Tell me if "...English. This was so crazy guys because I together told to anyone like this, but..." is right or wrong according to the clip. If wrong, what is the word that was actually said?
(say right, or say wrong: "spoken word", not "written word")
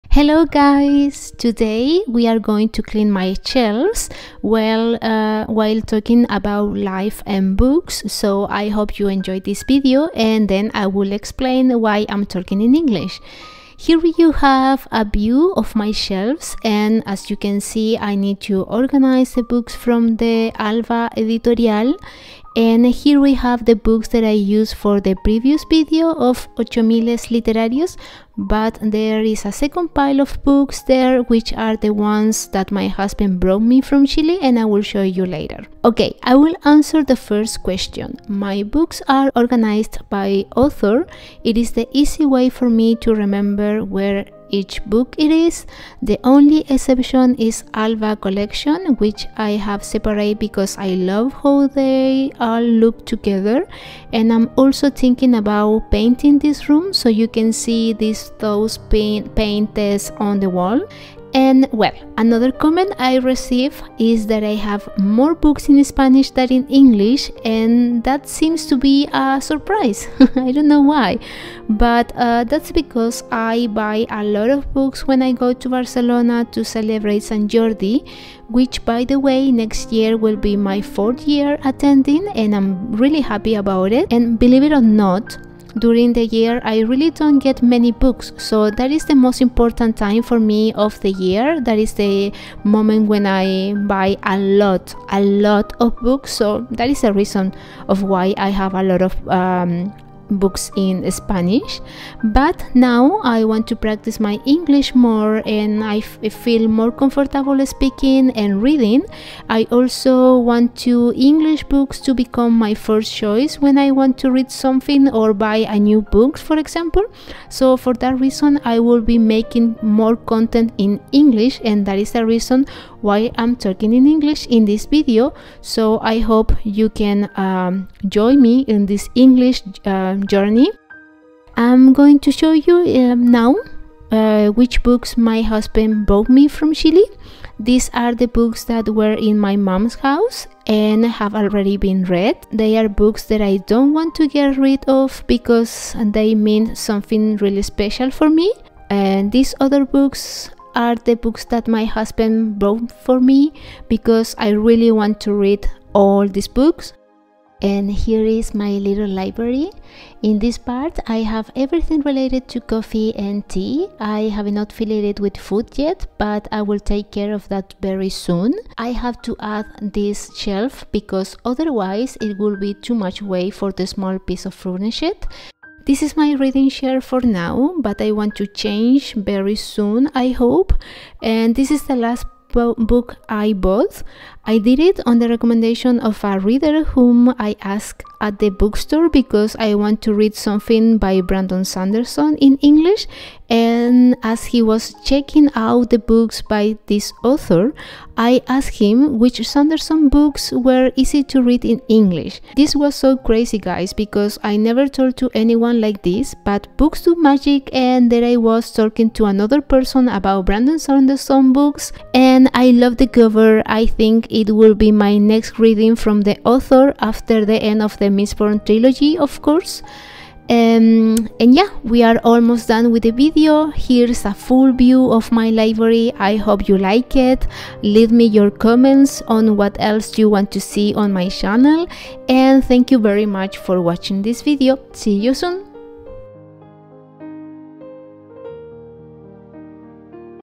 wrong: "never", not "together".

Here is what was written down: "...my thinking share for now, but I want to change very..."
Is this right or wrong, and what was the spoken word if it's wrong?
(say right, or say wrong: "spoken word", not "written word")
wrong: "reading", not "thinking".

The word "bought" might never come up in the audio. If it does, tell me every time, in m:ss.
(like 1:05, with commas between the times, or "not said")
2:16, 2:32, 3:03.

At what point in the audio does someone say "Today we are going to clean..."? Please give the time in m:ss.
0:01.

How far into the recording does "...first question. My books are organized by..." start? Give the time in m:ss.
0:37.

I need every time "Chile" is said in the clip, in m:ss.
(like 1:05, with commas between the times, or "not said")
0:34, 2:16.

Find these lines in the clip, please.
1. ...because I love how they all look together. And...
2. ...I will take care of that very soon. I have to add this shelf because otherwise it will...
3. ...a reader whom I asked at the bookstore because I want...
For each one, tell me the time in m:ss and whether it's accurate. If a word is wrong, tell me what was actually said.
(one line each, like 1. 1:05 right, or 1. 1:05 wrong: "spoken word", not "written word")
1. 0:50 right
2. 2:46 right
3. 3:06 right.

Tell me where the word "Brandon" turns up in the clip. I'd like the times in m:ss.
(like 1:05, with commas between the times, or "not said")
3:11, 3:30.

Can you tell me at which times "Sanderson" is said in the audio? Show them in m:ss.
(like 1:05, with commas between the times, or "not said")
3:11, 3:19, 3:30.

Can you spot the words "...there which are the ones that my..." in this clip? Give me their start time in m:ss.
0:30.